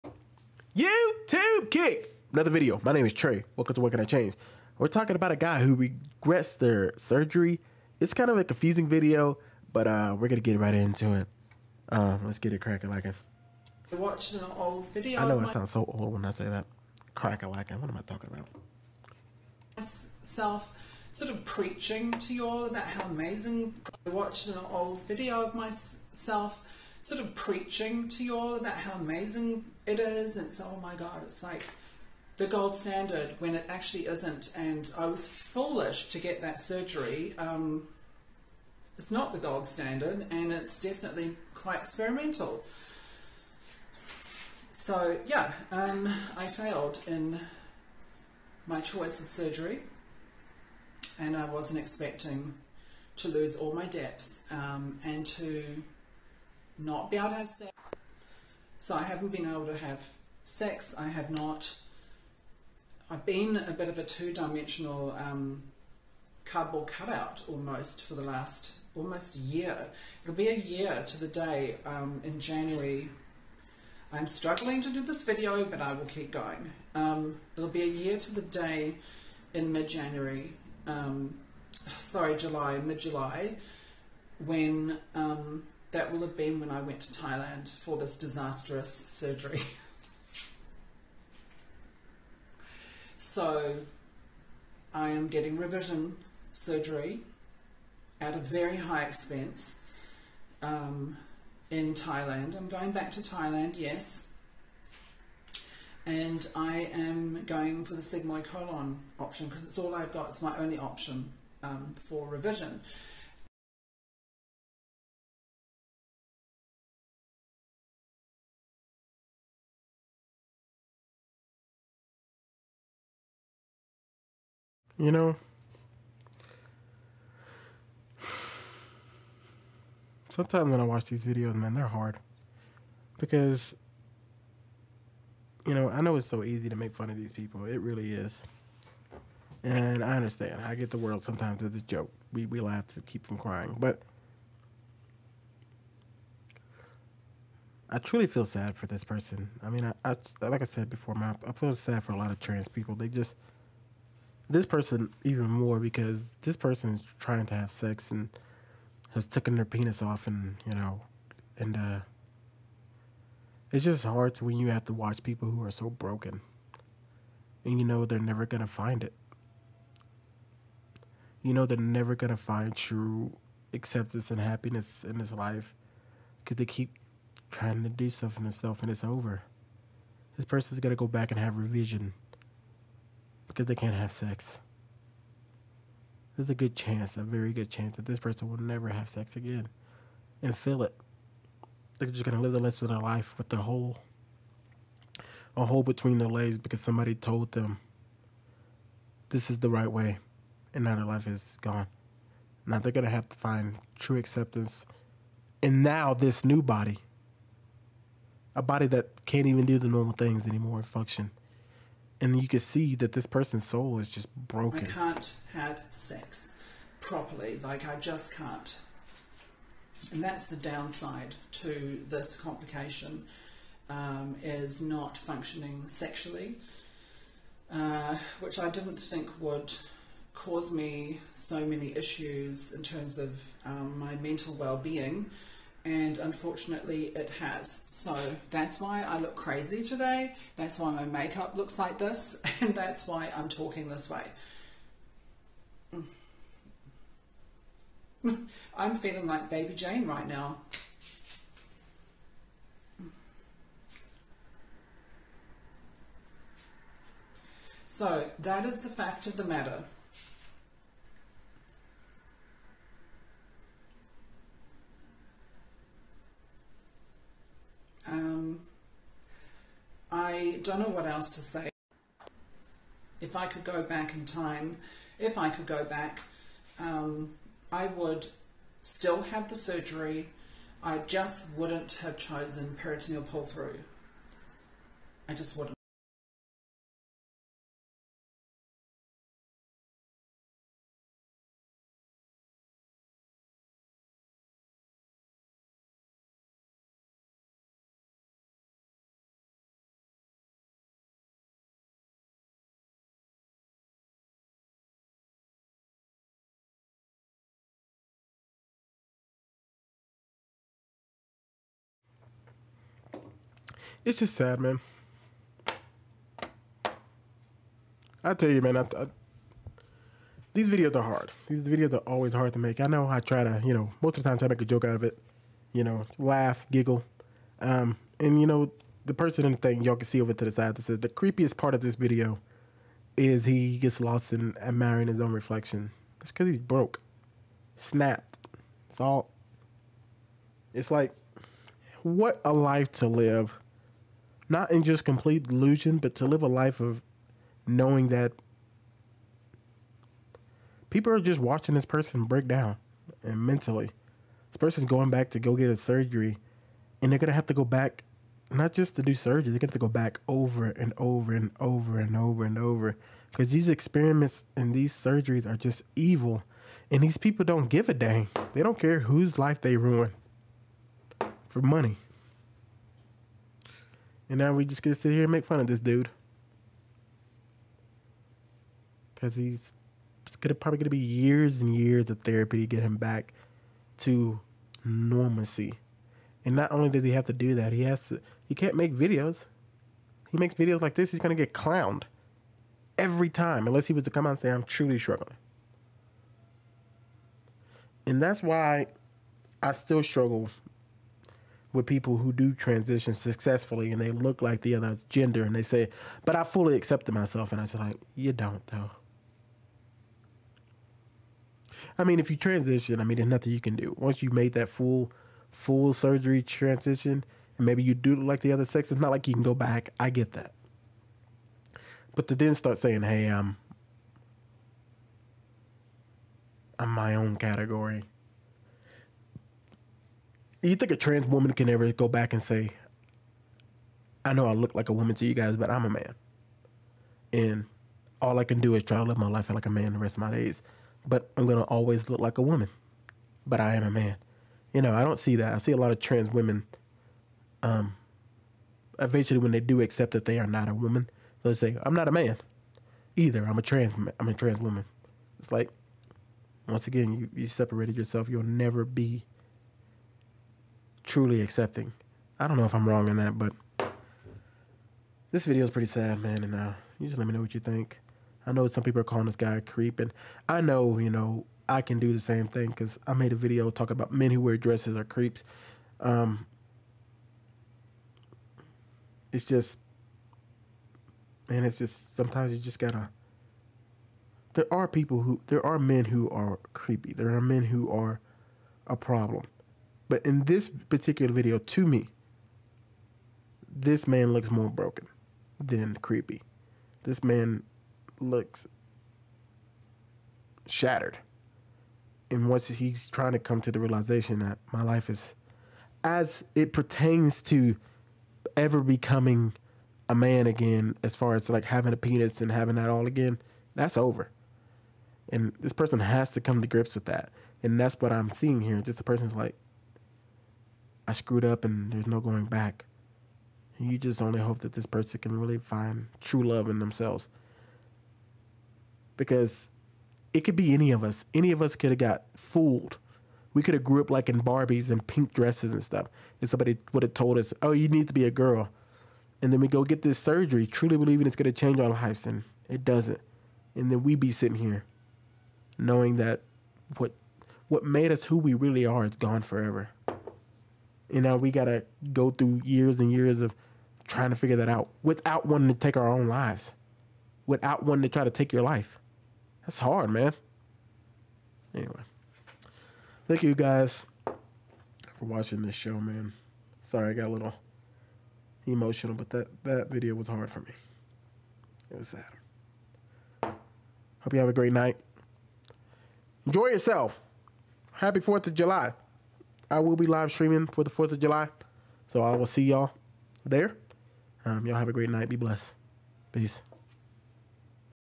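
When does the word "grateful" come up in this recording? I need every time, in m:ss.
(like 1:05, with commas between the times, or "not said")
not said.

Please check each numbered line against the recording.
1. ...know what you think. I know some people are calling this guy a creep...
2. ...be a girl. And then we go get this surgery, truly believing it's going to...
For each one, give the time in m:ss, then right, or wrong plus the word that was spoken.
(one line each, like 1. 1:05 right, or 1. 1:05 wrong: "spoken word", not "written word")
1. 7:47 right
2. 8:58 right.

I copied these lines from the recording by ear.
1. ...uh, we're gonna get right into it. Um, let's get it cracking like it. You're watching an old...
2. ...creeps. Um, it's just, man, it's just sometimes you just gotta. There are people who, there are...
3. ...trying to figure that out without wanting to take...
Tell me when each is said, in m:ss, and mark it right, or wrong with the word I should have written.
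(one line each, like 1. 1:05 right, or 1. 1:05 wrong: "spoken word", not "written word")
1. 0:09 right
2. 7:55 right
3. 9:14 right.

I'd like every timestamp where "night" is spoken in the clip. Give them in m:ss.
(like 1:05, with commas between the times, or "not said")
9:34, 9:45.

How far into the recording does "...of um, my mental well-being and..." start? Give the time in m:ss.
3:53.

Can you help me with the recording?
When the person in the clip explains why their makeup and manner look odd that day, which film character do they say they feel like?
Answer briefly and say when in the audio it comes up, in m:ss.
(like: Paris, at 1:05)
Baby Jane, at 4:09.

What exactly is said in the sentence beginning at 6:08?
They don't care whose life they ruin for money.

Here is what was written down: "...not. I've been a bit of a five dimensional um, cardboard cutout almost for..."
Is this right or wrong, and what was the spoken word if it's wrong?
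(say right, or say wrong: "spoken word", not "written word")
wrong: "two", not "five".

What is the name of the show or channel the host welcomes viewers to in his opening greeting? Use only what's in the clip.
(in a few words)
What Can I Change?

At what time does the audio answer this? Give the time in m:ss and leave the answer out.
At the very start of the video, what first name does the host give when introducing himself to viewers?
0:03.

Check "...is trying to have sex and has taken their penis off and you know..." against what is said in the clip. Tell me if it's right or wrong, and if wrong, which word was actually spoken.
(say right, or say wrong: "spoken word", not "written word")
right.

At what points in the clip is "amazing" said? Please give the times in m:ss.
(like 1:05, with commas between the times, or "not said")
0:23, 0:28.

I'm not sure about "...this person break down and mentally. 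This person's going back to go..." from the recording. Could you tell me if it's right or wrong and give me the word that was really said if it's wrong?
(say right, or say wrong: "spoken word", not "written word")
right.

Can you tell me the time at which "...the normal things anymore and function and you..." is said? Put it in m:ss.
3:29.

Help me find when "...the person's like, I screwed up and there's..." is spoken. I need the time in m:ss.
8:38.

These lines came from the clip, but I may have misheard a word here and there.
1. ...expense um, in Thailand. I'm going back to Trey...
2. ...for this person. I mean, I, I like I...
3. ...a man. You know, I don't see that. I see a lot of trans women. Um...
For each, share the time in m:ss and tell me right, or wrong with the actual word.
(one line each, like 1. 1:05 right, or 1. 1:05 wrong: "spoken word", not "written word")
1. 1:39 wrong: "Thailand", not "Trey"
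2. 2:28 right
3. 7:23 right.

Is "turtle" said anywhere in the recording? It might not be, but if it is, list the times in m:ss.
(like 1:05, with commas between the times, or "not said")
not said.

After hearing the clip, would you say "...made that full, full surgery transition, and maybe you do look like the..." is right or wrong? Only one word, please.
right.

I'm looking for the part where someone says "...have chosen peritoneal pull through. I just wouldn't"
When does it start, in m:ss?
4:42.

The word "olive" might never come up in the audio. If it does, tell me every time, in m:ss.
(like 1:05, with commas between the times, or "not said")
not said.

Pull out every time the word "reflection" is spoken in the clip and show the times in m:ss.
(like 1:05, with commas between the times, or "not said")
5:35.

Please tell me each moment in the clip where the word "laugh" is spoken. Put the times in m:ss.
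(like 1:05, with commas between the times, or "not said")
2:22, 5:26.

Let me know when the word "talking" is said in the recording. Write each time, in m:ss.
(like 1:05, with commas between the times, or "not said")
0:04, 0:18, 4:03, 7:53.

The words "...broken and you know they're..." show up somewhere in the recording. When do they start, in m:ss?
2:45.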